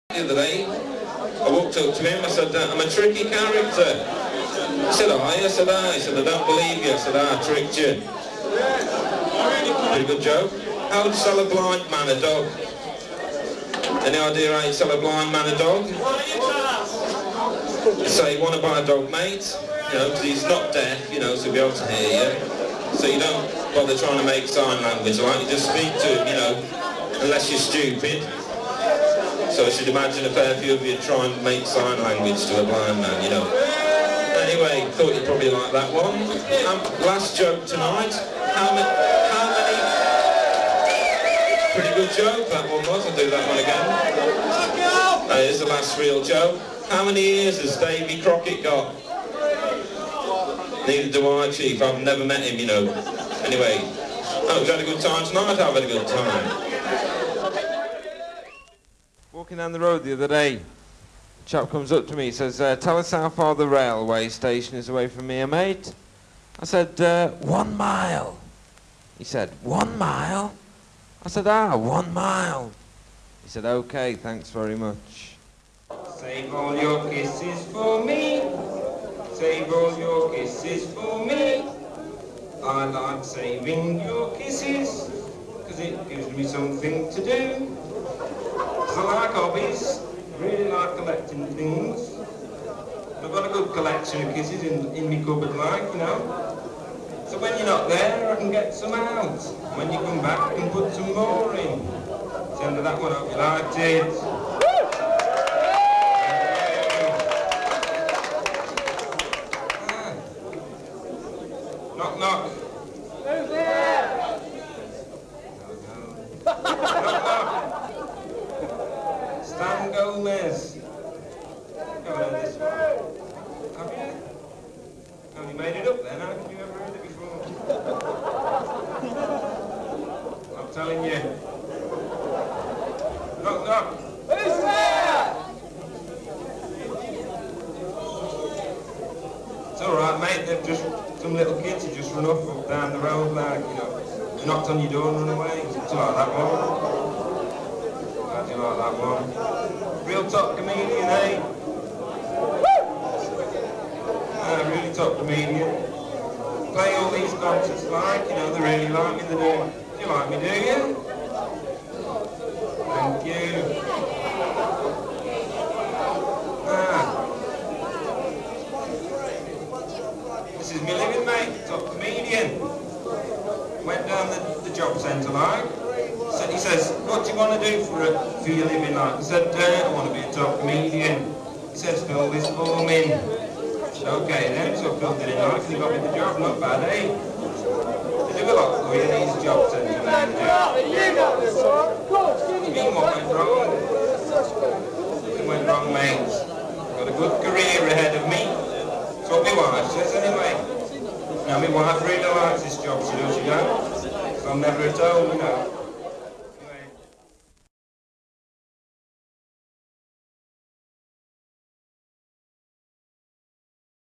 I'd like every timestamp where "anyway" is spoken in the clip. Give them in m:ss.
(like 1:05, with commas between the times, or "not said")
0:34, 0:53, 3:20.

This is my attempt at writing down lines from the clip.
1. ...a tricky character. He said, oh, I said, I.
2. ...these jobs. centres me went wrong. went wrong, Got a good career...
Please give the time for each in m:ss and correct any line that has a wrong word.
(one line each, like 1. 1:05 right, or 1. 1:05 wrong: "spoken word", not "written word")
1. 0:02 right
2. 3:09 right.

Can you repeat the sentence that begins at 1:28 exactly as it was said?
I like hobbies, really like collecting things.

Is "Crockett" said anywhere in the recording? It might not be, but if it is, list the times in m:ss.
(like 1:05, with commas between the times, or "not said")
0:48.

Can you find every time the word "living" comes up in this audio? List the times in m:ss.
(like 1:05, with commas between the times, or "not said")
2:50, 2:58.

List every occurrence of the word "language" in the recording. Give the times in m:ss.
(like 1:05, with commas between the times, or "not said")
0:24, 0:32.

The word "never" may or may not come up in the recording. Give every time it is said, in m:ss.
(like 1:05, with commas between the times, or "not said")
0:52, 3:24.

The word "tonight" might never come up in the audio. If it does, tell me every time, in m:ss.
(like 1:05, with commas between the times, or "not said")
0:37, 0:55.